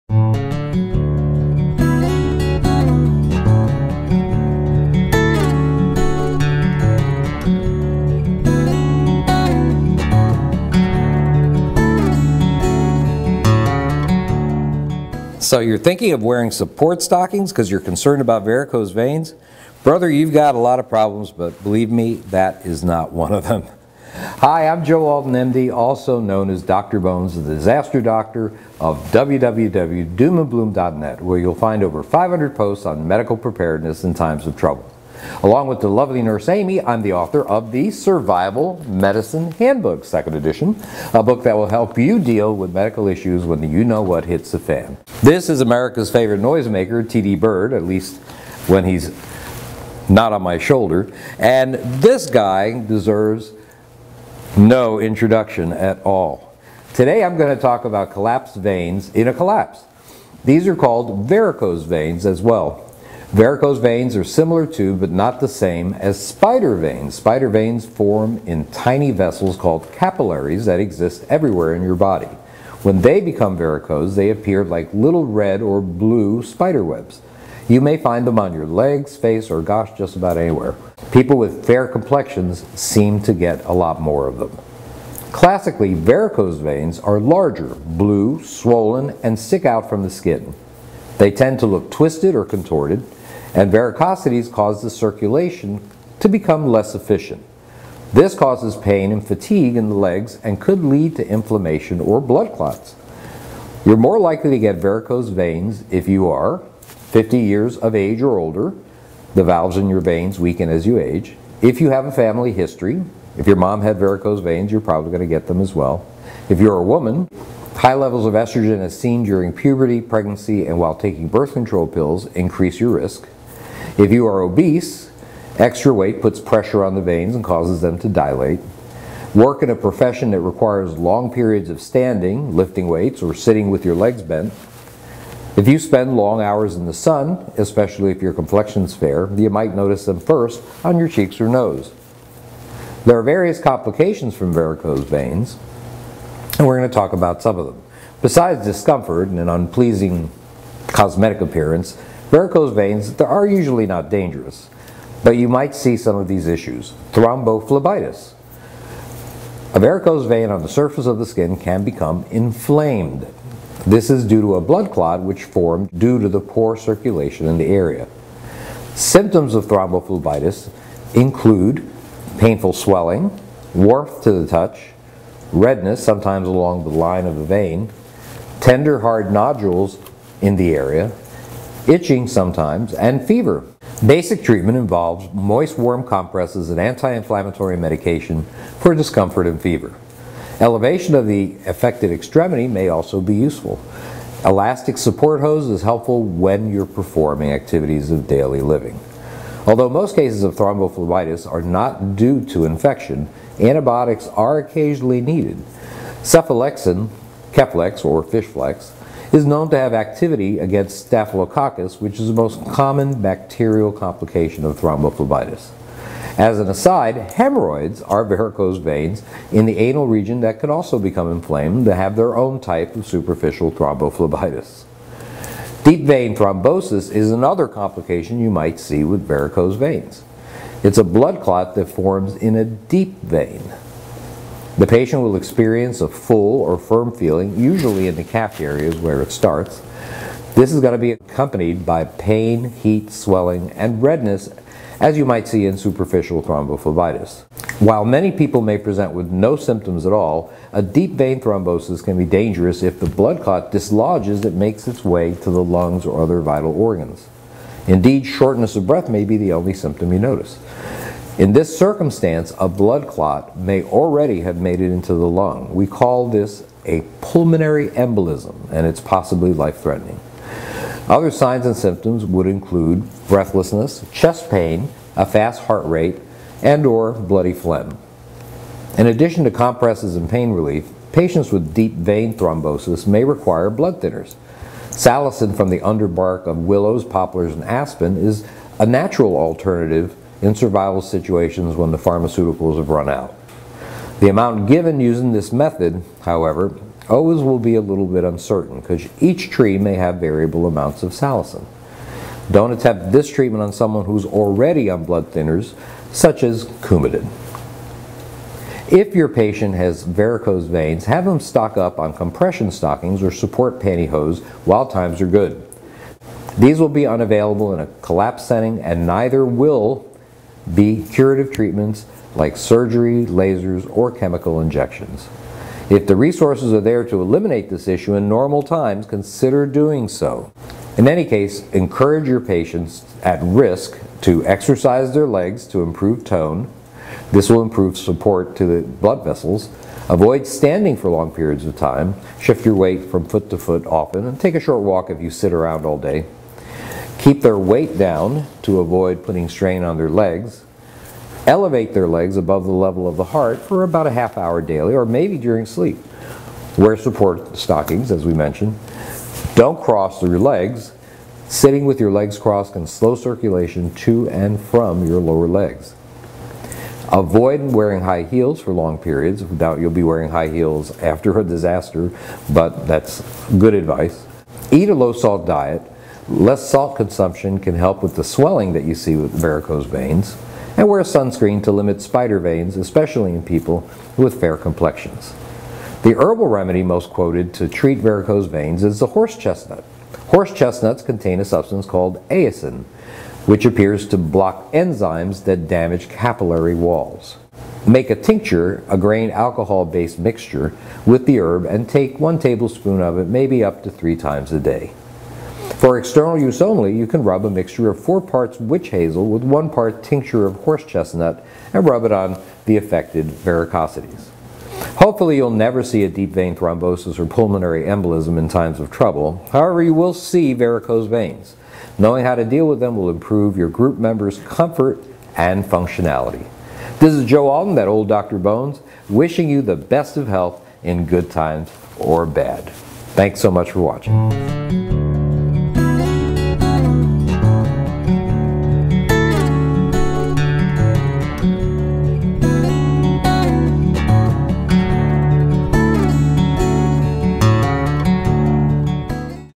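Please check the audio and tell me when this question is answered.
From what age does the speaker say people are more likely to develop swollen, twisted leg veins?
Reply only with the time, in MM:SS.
01:47.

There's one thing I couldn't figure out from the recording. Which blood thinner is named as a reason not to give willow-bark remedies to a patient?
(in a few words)
Coumadin.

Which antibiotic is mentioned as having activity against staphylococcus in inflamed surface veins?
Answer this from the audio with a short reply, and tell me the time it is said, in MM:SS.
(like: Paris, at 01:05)
Cephalexin, at 03:26.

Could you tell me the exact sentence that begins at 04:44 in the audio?
Salicin from the underbark of willows, poplars, and aspen is a natural alternative in survival situations when the pharmaceuticals have run out.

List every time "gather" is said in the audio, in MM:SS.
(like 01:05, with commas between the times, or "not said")
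not said.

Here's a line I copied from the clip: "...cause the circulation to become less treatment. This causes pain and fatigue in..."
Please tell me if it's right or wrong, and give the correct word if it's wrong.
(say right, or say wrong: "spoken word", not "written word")
wrong: "efficient", not "treatment".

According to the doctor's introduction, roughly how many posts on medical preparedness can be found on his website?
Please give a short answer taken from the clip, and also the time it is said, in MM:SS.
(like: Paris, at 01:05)
over 500, at 00:31.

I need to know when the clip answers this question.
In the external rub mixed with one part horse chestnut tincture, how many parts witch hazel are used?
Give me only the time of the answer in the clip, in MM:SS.
06:47.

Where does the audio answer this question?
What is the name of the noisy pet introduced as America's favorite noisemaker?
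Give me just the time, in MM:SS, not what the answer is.
00:47.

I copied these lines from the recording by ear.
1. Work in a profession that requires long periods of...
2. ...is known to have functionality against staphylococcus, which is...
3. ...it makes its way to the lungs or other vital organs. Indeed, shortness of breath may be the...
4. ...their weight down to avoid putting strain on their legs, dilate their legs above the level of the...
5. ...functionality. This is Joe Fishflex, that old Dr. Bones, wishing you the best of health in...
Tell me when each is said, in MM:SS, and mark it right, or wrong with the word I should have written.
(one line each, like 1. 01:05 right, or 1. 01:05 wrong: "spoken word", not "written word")
1. 02:09 right
2. 03:29 wrong: "activity", not "functionality"
3. 04:14 right
4. 05:47 wrong: "elevate", not "dilate"
5. 07:05 wrong: "Alton", not "Fishflex".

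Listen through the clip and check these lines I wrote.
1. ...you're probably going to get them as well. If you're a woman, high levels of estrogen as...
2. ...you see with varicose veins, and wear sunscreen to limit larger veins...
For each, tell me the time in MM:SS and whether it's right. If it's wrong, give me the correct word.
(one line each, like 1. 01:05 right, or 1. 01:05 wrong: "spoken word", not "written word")
1. 01:54 right
2. 06:18 wrong: "spider", not "larger".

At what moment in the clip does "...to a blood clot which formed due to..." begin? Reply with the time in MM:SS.
02:44.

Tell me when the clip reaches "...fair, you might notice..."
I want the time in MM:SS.
02:18.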